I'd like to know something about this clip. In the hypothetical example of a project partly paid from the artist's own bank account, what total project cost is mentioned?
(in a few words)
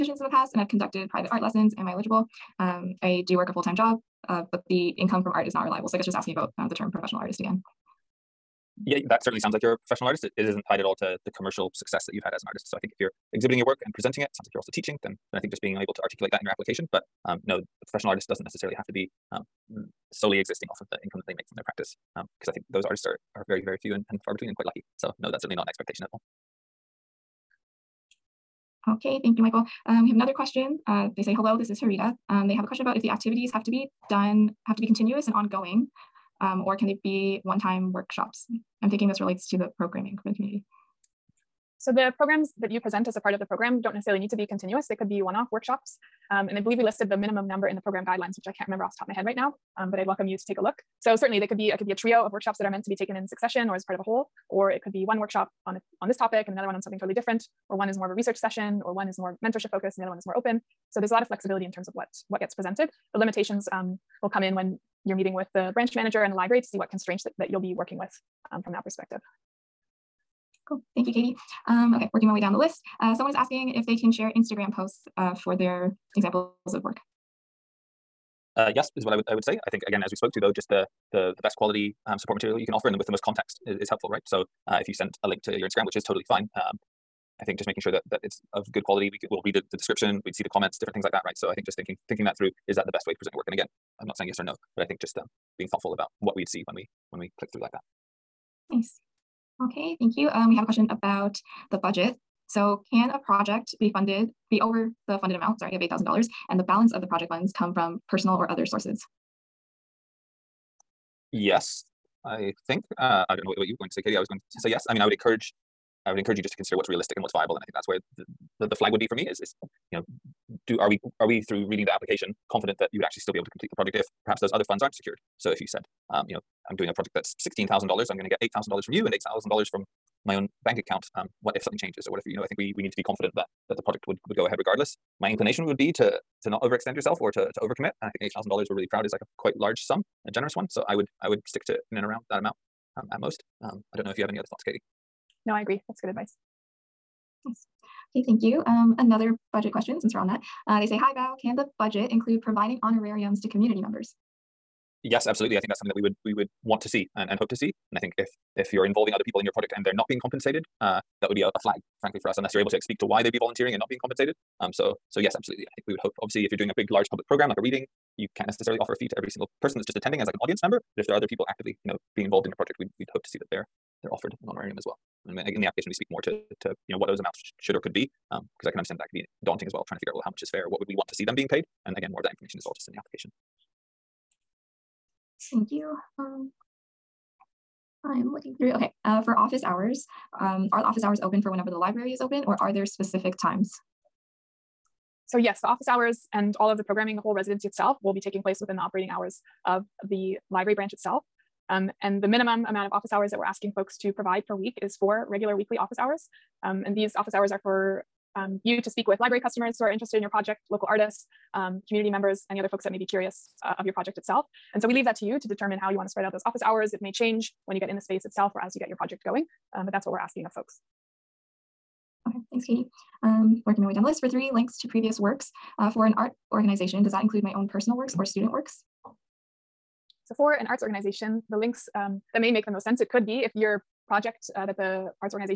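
$16,000.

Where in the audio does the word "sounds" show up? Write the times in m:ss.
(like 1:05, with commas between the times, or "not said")
0:09, 0:14.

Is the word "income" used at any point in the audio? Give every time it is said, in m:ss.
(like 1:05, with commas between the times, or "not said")
0:04, 0:21.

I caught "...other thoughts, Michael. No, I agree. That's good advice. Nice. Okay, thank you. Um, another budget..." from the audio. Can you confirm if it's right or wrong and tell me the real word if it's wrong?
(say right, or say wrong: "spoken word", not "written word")
wrong: "Katie", not "Michael".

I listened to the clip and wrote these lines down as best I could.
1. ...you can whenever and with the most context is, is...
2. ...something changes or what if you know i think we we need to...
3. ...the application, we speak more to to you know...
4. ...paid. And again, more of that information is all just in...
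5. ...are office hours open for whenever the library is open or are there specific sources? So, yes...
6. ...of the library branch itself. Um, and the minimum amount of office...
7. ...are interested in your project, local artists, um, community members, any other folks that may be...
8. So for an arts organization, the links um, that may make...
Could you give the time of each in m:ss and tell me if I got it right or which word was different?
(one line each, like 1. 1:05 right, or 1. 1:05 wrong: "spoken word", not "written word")
1. 1:22 wrong: "offer", not "whenever"
2. 2:11 right
3. 2:55 right
4. 3:01 right
5. 3:10 wrong: "times", not "sources"
6. 3:19 right
7. 3:29 right
8. 3:50 right.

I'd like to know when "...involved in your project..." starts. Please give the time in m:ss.
2:52.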